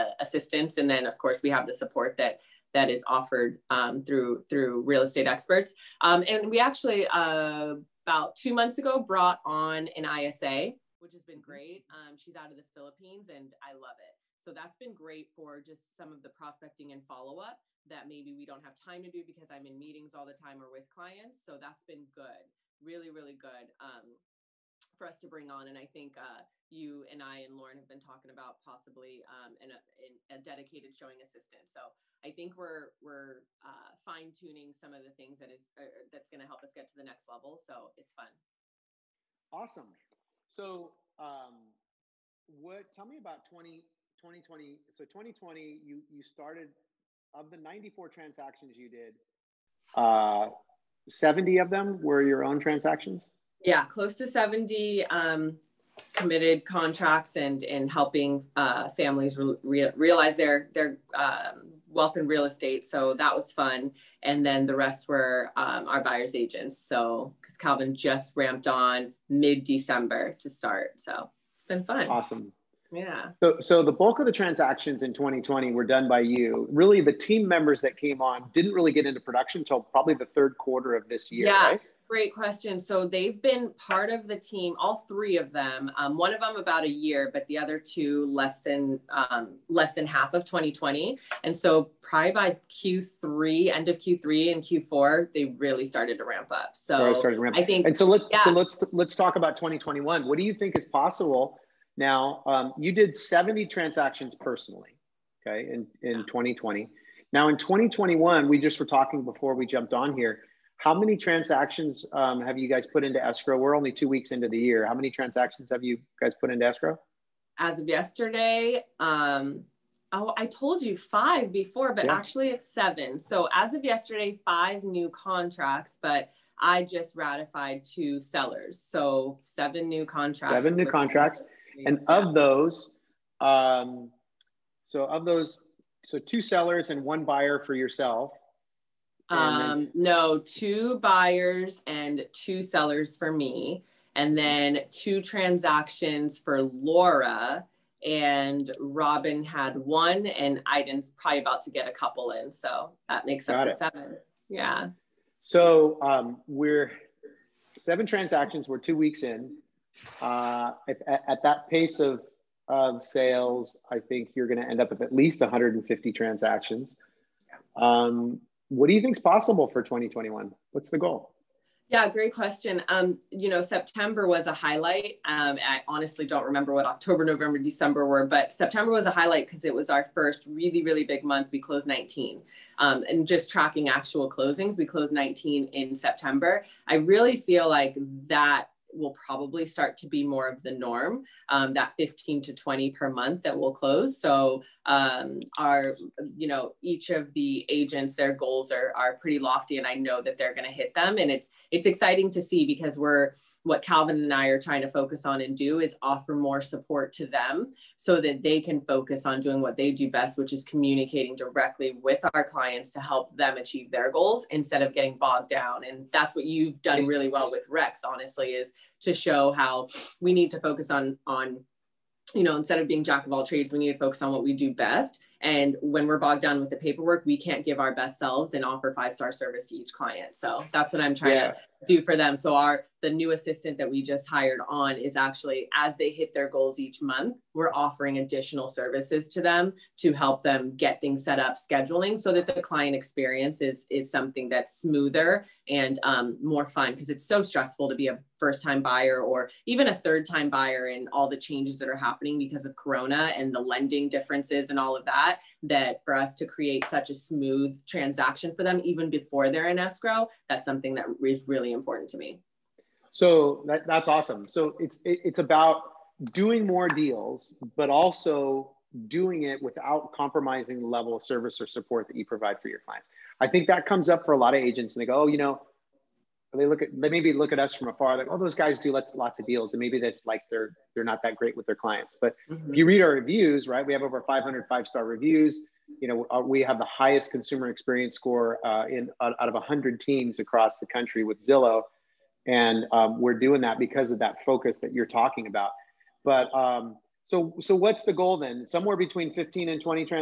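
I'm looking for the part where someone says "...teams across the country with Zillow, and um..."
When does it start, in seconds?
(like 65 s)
290 s.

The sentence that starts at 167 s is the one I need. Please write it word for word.
Um, what do you think is possible for 2021?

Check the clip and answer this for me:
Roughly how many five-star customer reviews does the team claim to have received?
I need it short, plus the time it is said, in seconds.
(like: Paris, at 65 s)
Over 500, at 284 s.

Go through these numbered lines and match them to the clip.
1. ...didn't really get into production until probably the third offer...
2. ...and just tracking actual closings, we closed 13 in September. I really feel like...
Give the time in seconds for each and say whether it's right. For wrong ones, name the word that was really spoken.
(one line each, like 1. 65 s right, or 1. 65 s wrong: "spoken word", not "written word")
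1. 78 s wrong: "quarter", not "offer"
2. 183 s wrong: "19", not "13".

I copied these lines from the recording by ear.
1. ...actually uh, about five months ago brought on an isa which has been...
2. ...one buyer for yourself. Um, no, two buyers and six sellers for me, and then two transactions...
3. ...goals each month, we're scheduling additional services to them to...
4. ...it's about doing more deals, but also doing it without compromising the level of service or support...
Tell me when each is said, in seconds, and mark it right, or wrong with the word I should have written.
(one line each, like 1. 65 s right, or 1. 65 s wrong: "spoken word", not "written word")
1. 6 s wrong: "two", not "five"
2. 137 s wrong: "two", not "six"
3. 236 s wrong: "offering", not "scheduling"
4. 265 s right.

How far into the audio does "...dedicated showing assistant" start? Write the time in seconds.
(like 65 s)
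30 s.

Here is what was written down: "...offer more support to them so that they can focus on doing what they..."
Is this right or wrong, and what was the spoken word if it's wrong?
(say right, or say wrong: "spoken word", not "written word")
right.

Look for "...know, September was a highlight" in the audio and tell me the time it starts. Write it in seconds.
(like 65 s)
173 s.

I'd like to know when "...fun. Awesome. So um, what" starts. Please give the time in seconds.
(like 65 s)
38 s.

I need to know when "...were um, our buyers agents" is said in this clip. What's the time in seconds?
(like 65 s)
65 s.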